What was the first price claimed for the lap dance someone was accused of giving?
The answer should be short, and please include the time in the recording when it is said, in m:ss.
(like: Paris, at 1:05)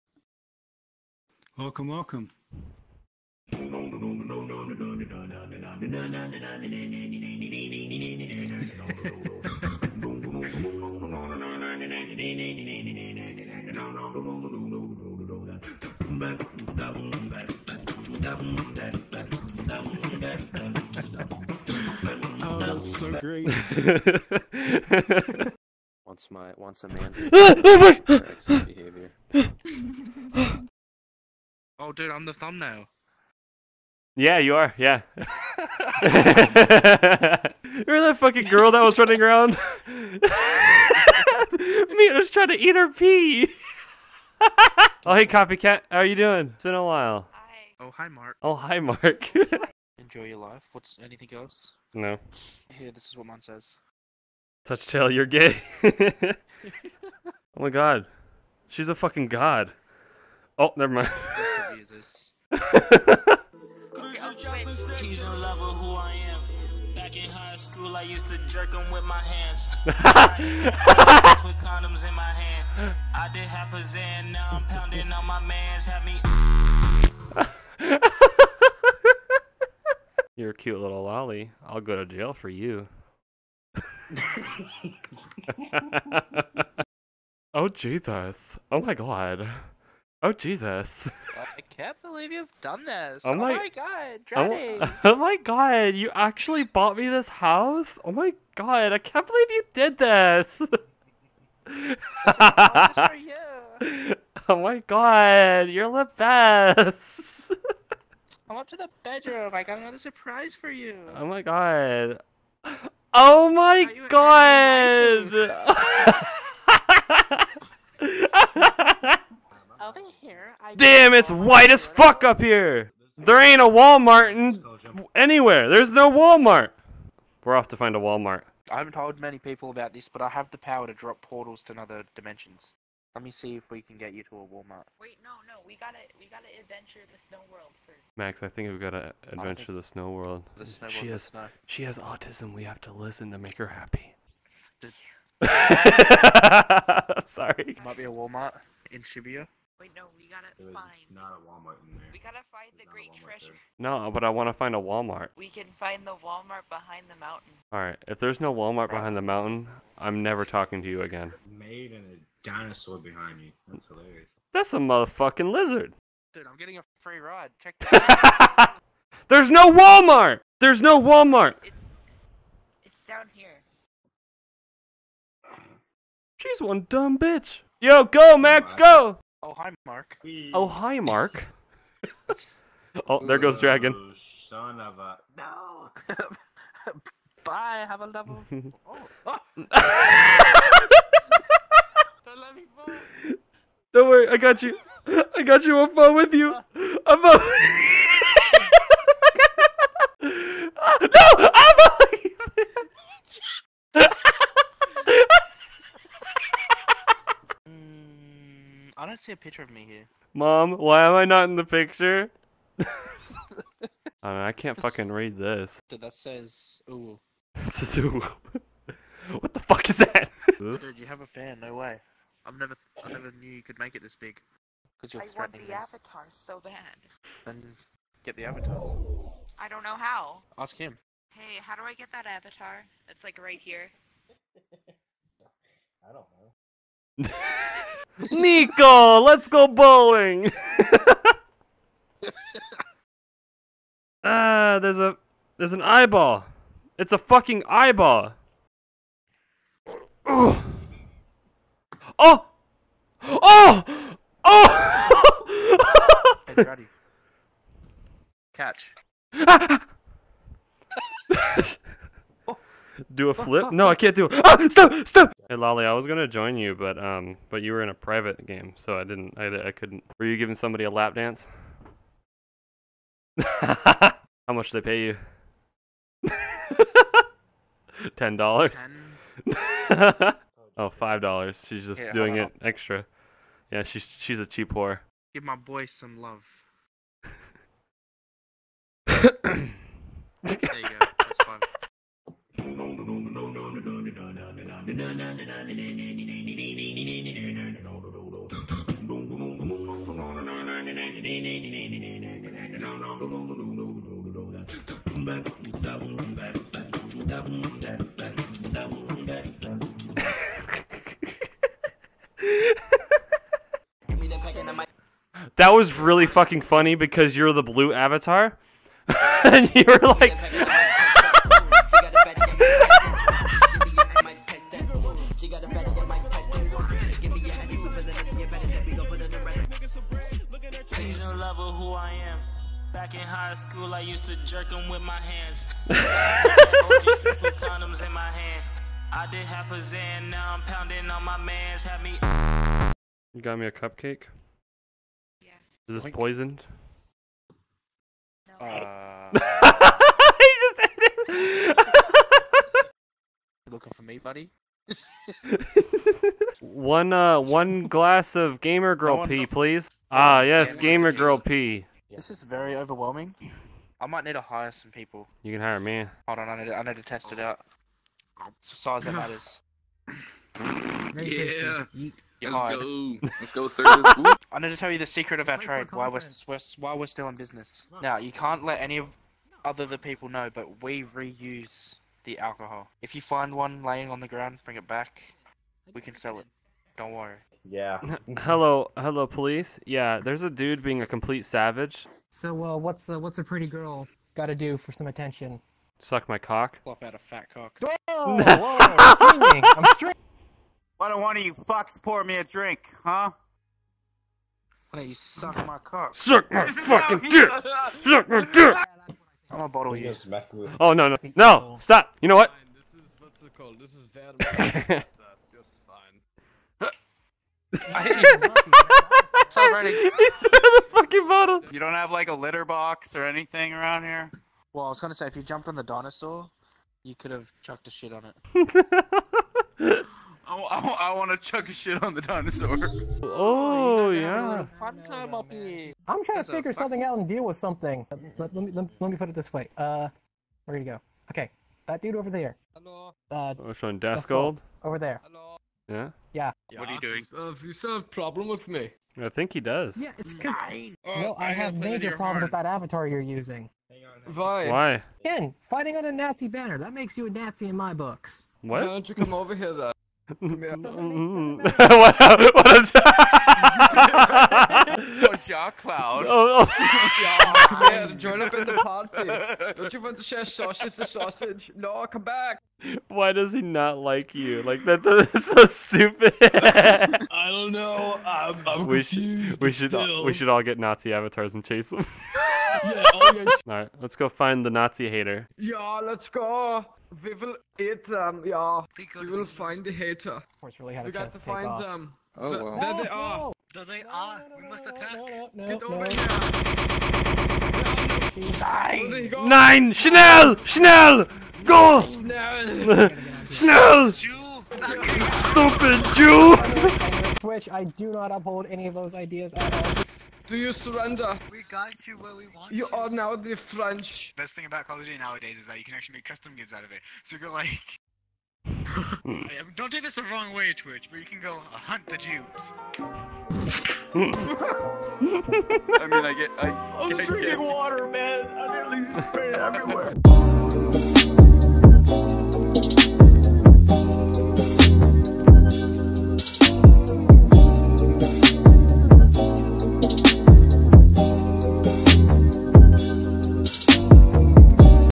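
$10, at 4:38.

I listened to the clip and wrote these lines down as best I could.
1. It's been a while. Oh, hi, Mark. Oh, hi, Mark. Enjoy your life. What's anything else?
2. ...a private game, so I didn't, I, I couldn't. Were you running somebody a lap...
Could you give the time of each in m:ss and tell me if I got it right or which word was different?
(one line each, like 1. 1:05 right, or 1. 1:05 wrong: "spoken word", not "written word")
1. 0:46 right
2. 4:27 wrong: "giving", not "running".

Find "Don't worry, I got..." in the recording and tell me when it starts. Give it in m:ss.
3:13.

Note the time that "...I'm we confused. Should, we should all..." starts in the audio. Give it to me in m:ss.
7:58.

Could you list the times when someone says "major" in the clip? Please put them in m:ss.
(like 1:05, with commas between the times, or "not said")
7:31.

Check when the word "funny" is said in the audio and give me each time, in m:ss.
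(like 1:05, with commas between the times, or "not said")
5:16.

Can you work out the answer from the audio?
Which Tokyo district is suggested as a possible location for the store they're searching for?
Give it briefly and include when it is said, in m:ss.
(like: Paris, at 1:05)
Shibuya, at 2:29.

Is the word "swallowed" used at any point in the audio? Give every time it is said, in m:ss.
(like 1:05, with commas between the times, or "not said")
not said.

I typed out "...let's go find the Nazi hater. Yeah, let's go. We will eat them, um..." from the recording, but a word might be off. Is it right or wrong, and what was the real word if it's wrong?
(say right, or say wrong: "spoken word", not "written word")
right.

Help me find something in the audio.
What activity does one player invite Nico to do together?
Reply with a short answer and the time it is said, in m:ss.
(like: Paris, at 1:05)
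Bowling, at 3:59.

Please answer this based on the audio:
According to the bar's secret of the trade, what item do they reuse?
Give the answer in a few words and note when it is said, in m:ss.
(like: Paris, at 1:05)
The alcohol, at 6:22.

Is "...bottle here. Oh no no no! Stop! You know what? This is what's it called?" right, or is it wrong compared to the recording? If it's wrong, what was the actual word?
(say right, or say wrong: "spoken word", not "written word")
right.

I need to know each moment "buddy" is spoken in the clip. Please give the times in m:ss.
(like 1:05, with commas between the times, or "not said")
5:54.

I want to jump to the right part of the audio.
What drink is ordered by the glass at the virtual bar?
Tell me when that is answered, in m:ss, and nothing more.
6:00.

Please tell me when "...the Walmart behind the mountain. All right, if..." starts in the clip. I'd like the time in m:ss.
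2:36.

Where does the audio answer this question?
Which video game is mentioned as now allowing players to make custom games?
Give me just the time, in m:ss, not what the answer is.
8:34.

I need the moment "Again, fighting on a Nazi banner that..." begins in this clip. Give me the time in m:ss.
7:35.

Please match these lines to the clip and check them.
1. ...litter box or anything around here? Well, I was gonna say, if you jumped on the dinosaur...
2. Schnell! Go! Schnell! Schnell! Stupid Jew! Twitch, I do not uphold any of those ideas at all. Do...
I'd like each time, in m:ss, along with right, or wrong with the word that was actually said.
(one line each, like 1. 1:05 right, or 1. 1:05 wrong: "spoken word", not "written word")
1. 7:02 right
2. 8:20 right.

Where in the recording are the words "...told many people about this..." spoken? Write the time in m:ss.
2:08.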